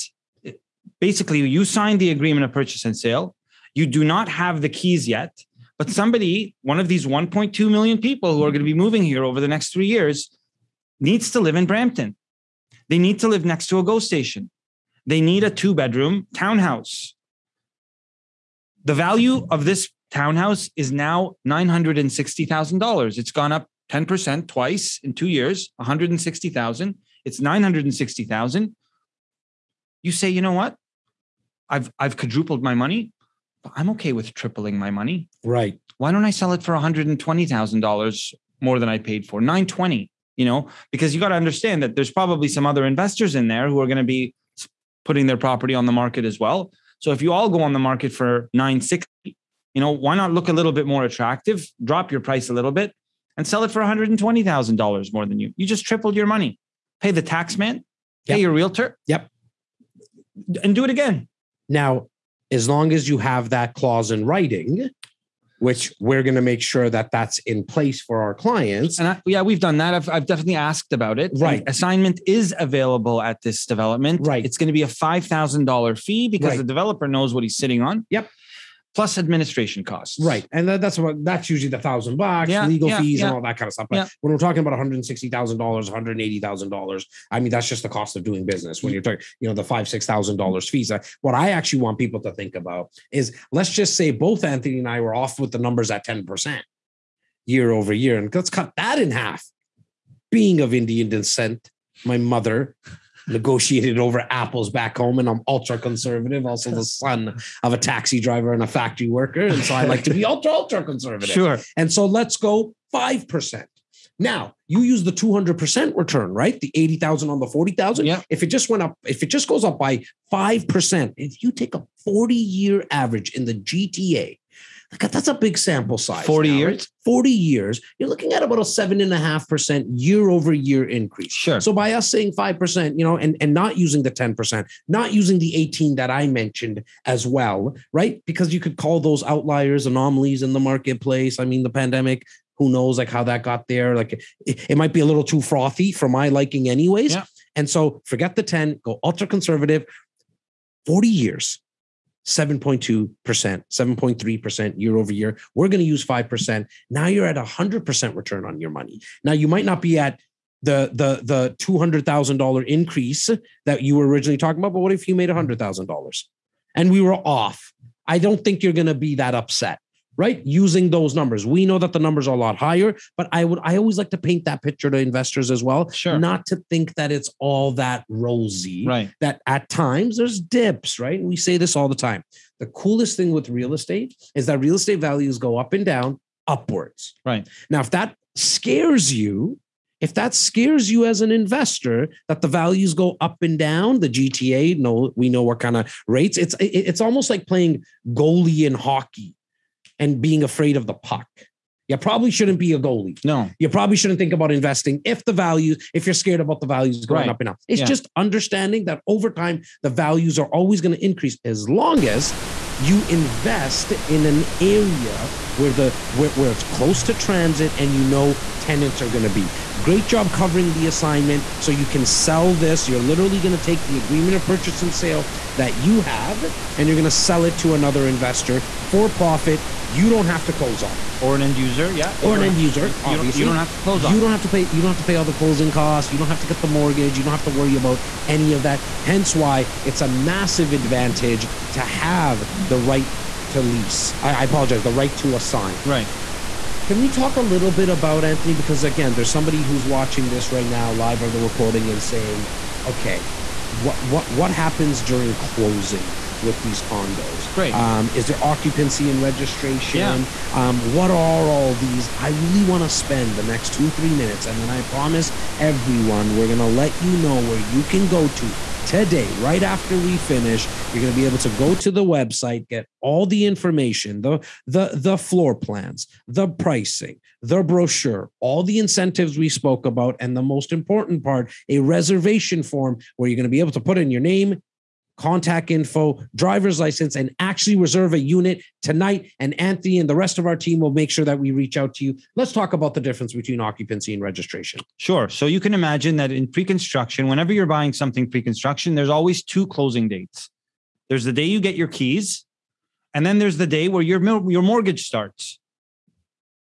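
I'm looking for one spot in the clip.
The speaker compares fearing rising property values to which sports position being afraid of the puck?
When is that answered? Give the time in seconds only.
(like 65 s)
198 s.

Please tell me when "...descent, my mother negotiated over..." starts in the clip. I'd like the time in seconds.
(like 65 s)
101 s.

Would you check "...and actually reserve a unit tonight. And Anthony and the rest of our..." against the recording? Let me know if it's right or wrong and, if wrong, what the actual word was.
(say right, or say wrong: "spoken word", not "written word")
right.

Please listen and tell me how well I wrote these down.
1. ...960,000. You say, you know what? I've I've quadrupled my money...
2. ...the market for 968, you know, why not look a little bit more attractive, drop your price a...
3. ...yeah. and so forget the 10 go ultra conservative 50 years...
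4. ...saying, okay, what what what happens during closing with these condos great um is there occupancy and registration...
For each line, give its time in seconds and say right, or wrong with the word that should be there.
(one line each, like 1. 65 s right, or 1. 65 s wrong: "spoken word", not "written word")
1. 27 s right
2. 47 s wrong: "960", not "968"
3. 147 s wrong: "40", not "50"
4. 252 s right.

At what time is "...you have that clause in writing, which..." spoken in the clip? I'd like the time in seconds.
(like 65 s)
63 s.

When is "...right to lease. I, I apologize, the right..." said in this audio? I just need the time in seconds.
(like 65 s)
242 s.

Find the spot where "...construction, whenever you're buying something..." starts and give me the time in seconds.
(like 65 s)
296 s.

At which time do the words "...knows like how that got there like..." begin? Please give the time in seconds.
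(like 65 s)
142 s.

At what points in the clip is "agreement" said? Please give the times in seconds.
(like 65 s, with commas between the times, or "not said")
2 s, 223 s.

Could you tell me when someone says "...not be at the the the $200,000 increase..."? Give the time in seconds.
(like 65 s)
159 s.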